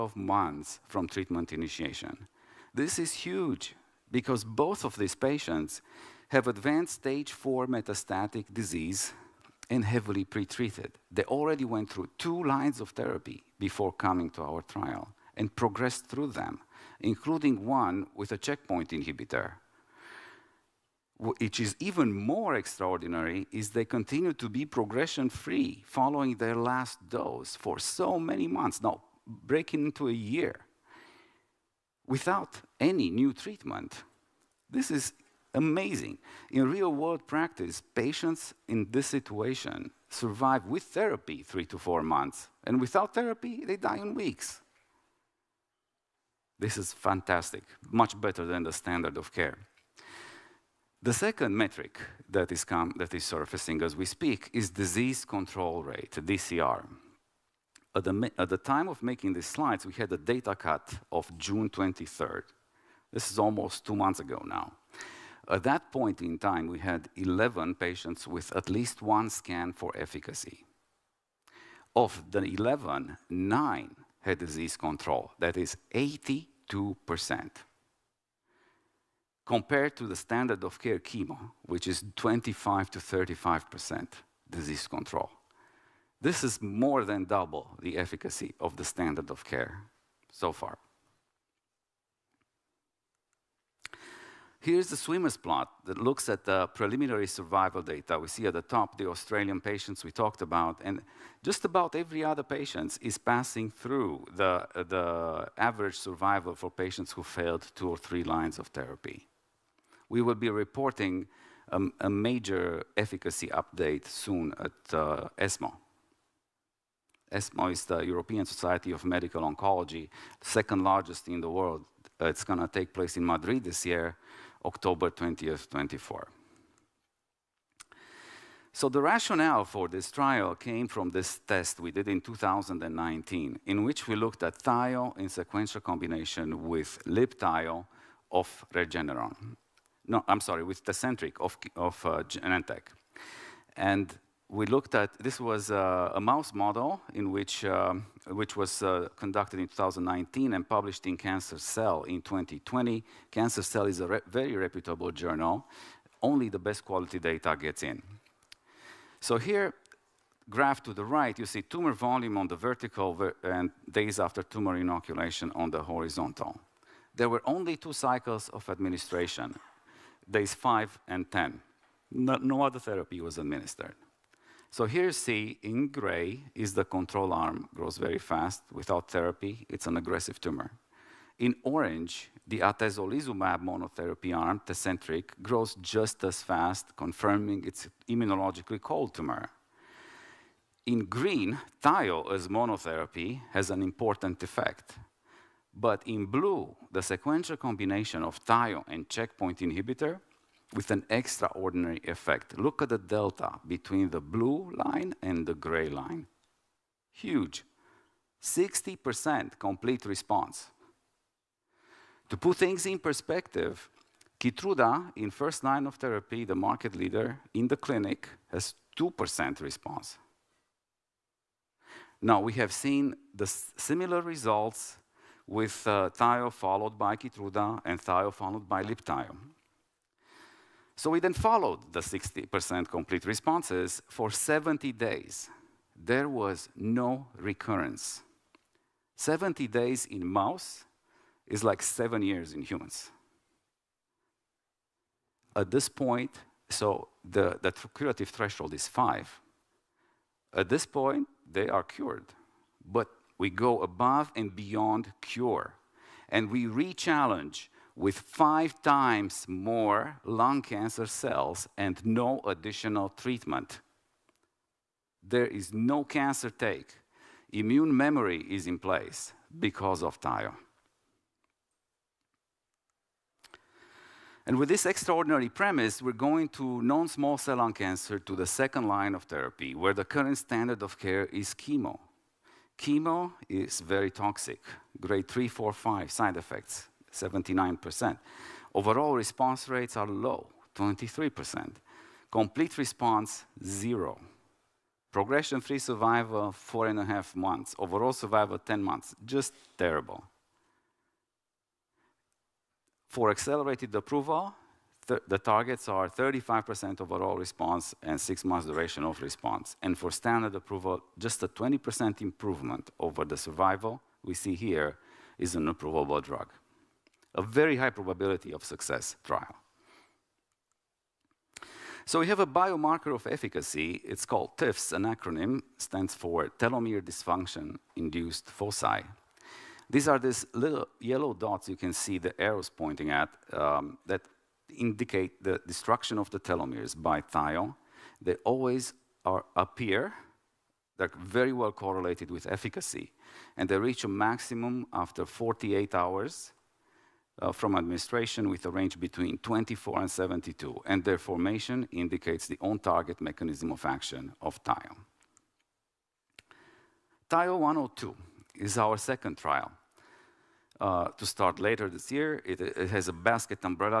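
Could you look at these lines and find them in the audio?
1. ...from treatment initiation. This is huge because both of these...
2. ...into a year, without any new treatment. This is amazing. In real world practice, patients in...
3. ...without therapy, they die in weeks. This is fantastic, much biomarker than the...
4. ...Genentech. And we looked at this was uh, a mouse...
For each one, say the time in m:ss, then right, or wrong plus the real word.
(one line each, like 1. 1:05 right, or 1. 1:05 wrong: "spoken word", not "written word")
1. 0:00 right
2. 0:29 right
3. 0:42 wrong: "better", not "biomarker"
4. 2:22 right.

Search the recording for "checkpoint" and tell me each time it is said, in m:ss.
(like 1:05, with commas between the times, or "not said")
0:18, 3:19.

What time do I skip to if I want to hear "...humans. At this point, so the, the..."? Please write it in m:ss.
4:02.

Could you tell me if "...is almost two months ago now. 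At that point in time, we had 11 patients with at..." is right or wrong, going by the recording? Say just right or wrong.
right.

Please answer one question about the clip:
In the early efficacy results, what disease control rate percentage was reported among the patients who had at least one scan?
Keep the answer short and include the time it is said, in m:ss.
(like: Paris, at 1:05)
82%, at 1:15.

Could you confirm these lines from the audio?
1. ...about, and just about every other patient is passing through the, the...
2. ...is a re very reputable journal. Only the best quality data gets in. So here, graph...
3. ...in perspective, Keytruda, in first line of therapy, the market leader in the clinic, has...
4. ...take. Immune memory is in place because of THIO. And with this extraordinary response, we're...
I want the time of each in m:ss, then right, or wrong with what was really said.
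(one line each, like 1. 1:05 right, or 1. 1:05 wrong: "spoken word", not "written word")
1. 1:40 right
2. 2:33 right
3. 3:32 right
4. 4:26 wrong: "premise", not "response".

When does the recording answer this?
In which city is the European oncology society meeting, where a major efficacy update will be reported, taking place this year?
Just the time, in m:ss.
2:03.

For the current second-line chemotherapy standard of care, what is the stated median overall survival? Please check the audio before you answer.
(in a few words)
10 months.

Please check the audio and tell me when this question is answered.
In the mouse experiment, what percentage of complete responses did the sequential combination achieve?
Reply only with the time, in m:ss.
3:28.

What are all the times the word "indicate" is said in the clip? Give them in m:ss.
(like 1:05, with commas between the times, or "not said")
5:34, 5:51.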